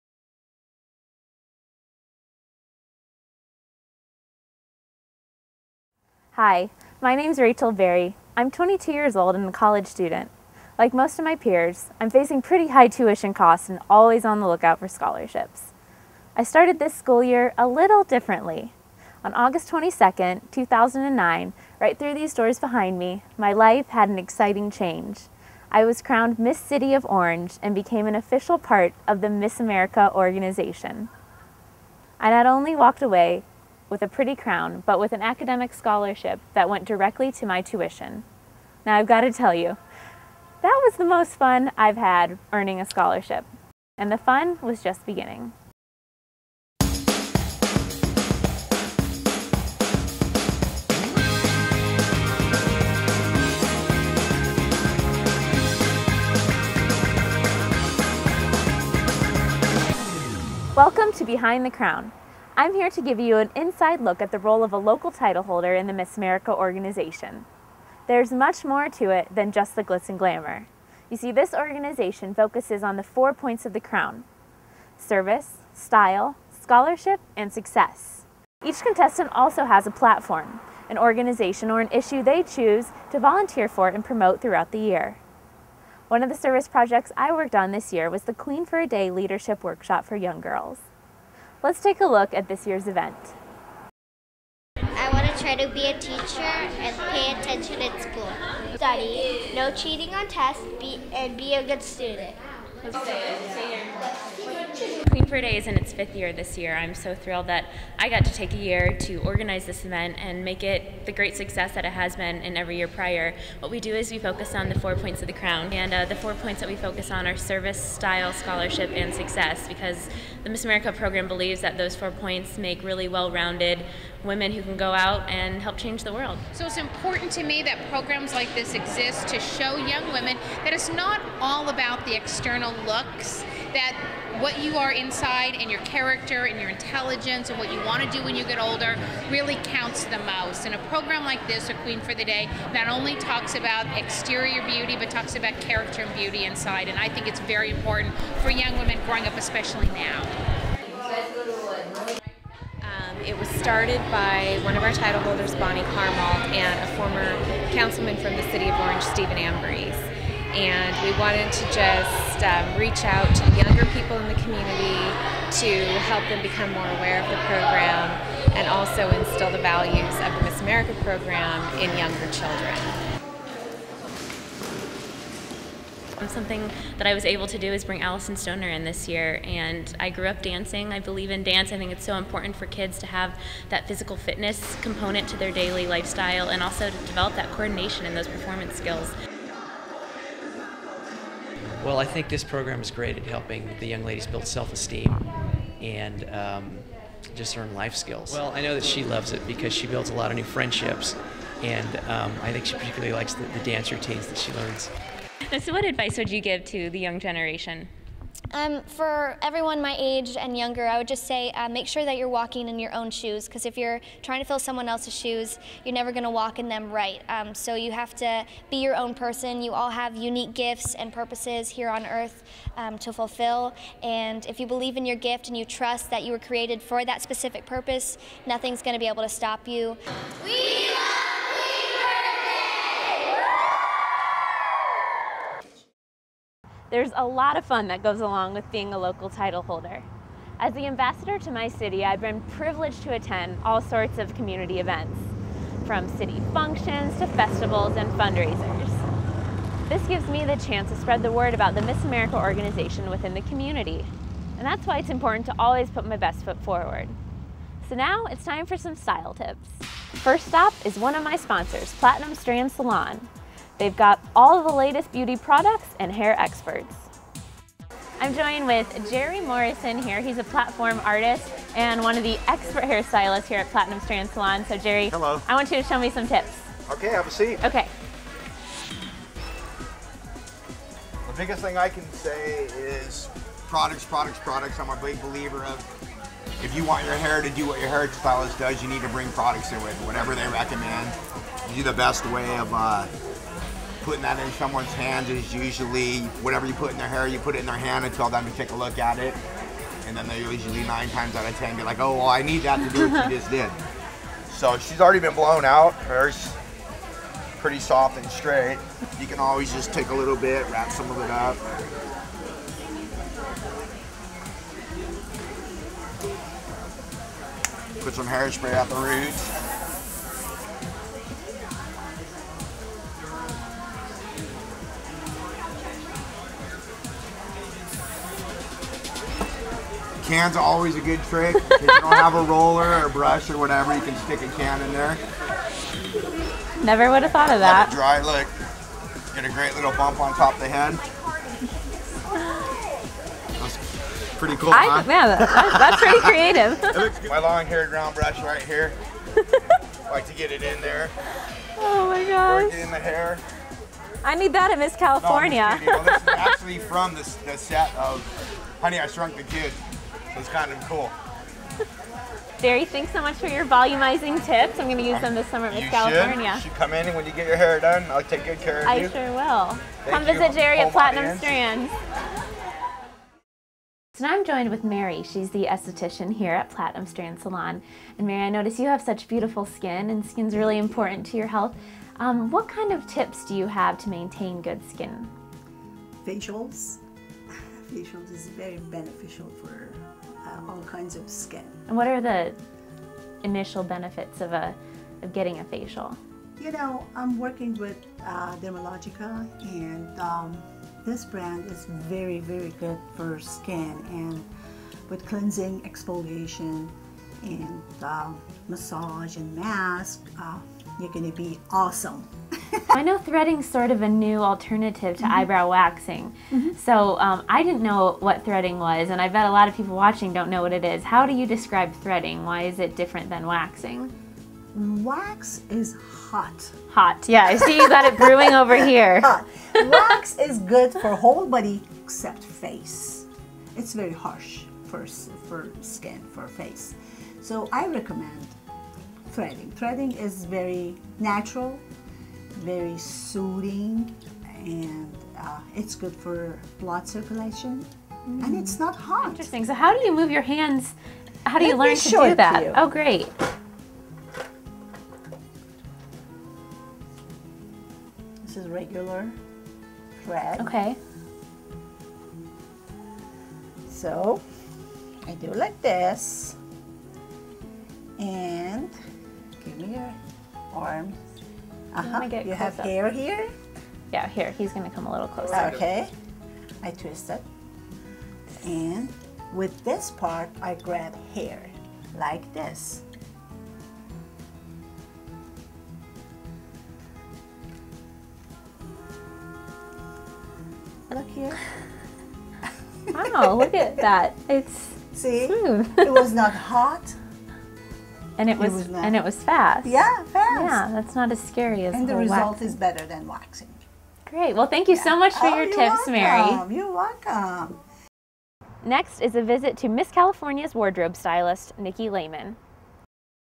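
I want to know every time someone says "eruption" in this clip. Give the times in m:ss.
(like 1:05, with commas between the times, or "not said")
not said.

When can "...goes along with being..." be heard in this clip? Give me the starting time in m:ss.
3:58.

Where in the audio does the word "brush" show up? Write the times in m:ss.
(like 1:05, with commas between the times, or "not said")
5:33, 5:48.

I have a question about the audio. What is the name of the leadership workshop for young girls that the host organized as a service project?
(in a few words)
Queen for a Day.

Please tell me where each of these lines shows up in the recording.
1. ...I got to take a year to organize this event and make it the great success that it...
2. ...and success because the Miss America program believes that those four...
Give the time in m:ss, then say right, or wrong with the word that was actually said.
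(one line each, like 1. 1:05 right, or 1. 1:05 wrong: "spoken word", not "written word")
1. 1:47 right
2. 1:58 right.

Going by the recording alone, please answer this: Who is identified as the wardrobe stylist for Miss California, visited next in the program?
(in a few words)
Nikki Lehman.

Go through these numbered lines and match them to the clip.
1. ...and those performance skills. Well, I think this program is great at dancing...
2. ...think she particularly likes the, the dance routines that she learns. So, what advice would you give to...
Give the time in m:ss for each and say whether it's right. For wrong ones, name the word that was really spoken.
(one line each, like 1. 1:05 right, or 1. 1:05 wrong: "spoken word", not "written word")
1. 3:08 wrong: "helping", not "dancing"
2. 3:22 right.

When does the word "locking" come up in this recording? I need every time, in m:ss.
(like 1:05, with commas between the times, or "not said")
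not said.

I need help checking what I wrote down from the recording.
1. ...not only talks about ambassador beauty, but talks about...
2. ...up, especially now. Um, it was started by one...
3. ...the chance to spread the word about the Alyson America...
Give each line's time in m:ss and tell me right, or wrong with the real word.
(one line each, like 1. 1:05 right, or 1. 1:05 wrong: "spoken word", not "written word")
1. 2:22 wrong: "exterior", not "ambassador"
2. 2:29 right
3. 4:10 wrong: "Miss", not "Alyson".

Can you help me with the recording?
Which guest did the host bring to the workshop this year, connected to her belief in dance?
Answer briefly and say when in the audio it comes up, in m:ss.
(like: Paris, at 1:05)
Alyson Stoner, at 2:58.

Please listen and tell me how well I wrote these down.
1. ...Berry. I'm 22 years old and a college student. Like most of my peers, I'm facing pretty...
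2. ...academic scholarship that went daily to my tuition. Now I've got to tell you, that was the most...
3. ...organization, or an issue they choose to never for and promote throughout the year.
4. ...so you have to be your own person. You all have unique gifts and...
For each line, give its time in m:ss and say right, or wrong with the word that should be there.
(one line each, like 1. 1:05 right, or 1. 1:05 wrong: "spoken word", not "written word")
1. 0:07 right
2. 0:35 wrong: "directly", not "daily"
3. 1:20 wrong: "volunteer", not "never"
4. 3:37 right.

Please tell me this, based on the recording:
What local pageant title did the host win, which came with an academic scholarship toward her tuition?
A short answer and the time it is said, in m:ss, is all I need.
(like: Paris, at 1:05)
Miss City of Orange, at 0:26.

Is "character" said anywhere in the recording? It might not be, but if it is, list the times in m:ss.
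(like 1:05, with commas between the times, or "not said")
2:15, 2:25.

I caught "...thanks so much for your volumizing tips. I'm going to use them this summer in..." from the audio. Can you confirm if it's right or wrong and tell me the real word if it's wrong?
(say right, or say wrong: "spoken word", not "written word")
right.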